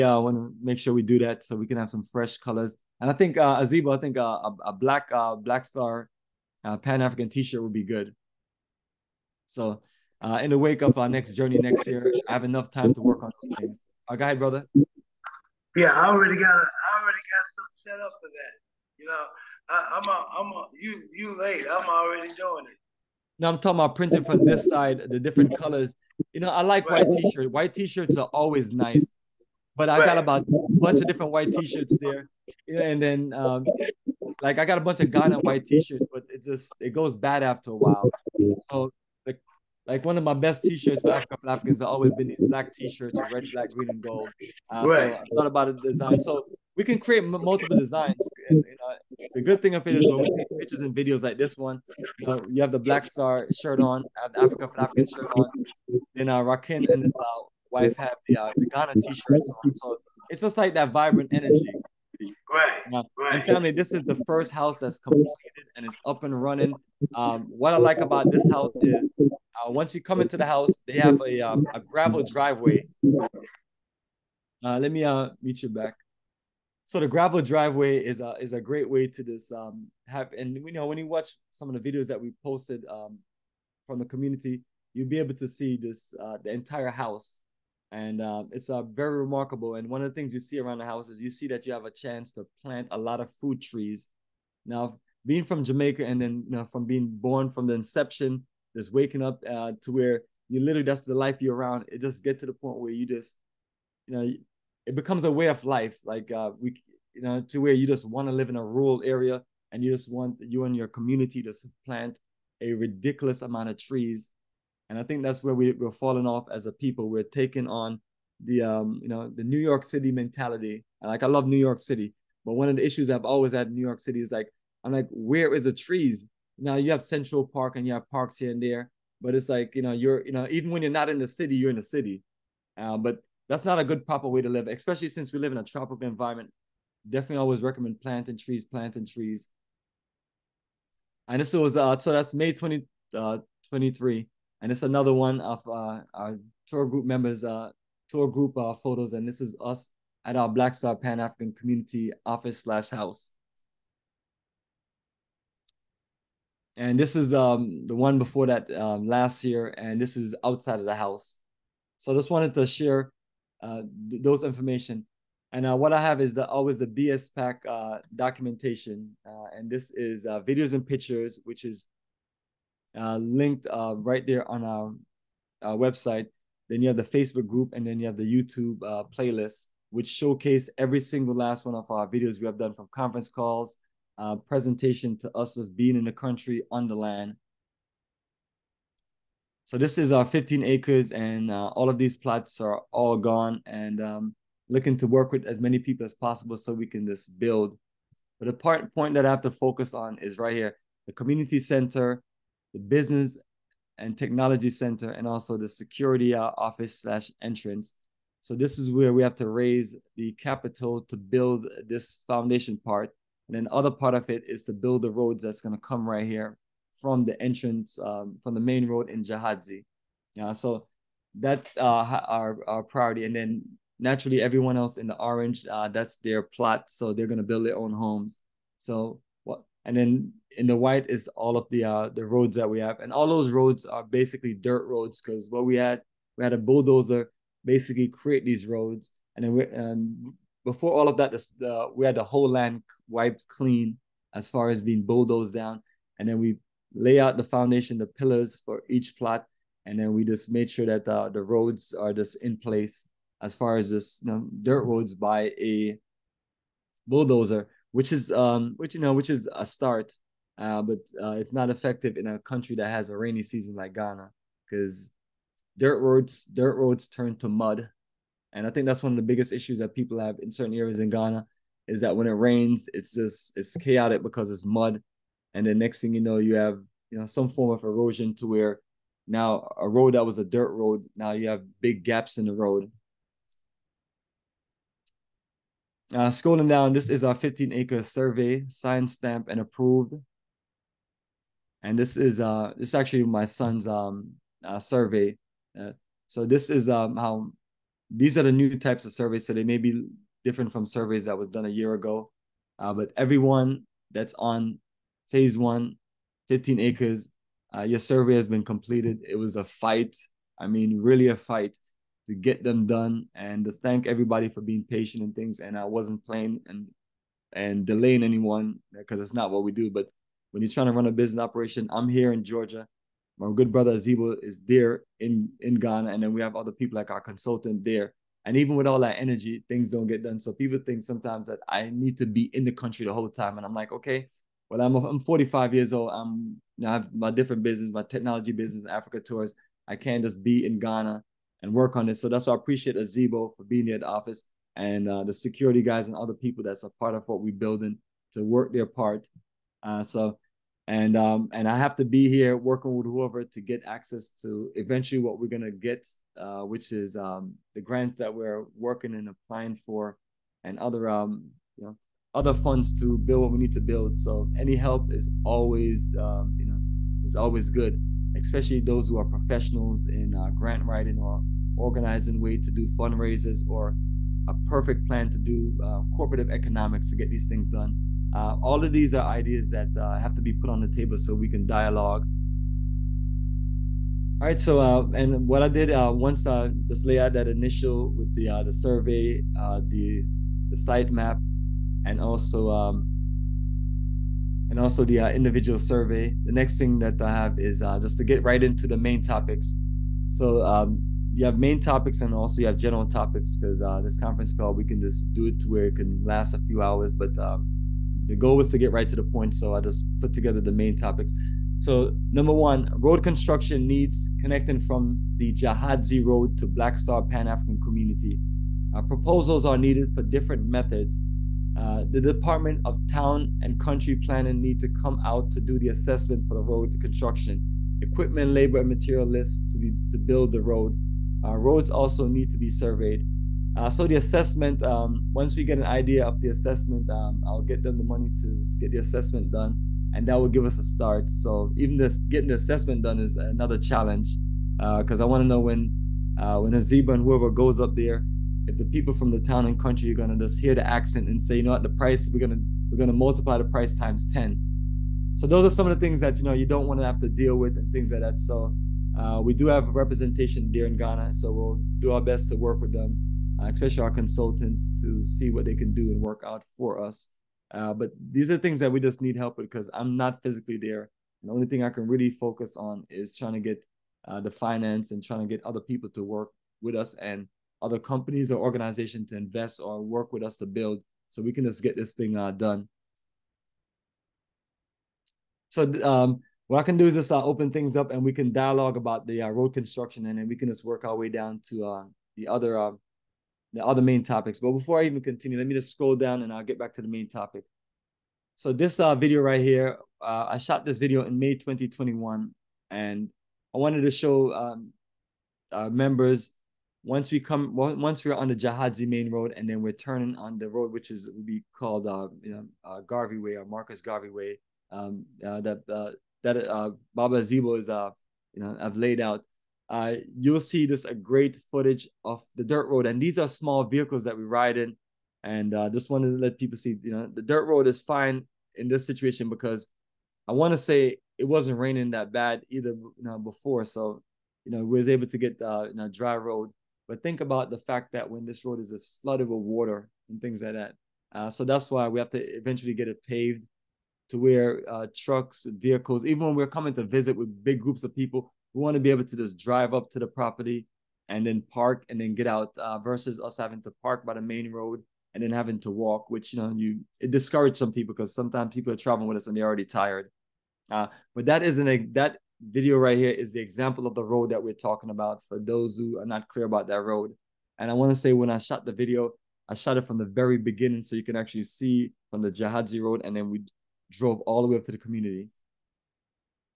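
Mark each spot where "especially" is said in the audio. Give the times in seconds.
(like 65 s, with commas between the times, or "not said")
134 s, 368 s, 463 s.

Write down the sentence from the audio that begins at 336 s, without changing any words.
I'm you know, I have my different business, my technology business, Africa tours.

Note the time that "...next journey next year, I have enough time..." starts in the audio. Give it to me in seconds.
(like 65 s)
11 s.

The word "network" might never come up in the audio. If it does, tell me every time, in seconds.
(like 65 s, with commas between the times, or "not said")
not said.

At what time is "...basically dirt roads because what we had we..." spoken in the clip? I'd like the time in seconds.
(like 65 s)
234 s.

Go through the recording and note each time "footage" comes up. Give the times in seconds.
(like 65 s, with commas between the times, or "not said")
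521 s.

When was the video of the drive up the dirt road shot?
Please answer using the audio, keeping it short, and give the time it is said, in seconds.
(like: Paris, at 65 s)
May 2021, at 501 s.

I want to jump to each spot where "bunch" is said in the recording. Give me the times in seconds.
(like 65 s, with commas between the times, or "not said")
30 s, 34 s.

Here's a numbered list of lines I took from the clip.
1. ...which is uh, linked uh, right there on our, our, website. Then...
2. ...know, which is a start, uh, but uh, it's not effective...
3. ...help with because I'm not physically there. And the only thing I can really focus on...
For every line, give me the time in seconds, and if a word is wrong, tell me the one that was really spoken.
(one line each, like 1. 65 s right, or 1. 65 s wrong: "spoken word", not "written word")
1. 171 s right
2. 259 s right
3. 469 s right.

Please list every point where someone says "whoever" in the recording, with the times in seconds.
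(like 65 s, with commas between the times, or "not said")
353 s, 447 s.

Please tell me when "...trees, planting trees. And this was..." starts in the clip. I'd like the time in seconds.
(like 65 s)
138 s.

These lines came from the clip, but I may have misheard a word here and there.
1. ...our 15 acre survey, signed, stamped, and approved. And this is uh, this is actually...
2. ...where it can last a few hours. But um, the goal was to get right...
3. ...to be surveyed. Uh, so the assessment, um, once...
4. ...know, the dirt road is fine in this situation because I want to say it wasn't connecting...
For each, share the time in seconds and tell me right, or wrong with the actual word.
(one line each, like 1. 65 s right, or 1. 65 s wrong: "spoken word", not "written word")
1. 287 s right
2. 405 s right
3. 432 s right
4. 527 s wrong: "raining", not "connecting".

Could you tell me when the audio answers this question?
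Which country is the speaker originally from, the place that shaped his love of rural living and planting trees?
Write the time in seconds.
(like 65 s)
95 s.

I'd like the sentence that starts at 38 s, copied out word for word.
So like one of my best t-shirts for African Africans have always been these black t-shirts red, black, green, and gold.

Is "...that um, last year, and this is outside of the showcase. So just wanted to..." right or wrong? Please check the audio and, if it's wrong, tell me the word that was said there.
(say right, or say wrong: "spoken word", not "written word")
wrong: "house", not "showcase".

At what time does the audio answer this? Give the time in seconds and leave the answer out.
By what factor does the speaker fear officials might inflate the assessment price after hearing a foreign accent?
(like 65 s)
454 s.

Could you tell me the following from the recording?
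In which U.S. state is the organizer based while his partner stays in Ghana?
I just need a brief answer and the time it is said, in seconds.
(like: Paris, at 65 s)
Georgia, at 322 s.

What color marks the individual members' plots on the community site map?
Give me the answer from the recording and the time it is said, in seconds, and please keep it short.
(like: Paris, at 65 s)
Orange, at 225 s.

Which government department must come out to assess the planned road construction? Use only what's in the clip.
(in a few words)
Department of Town and Country Planning.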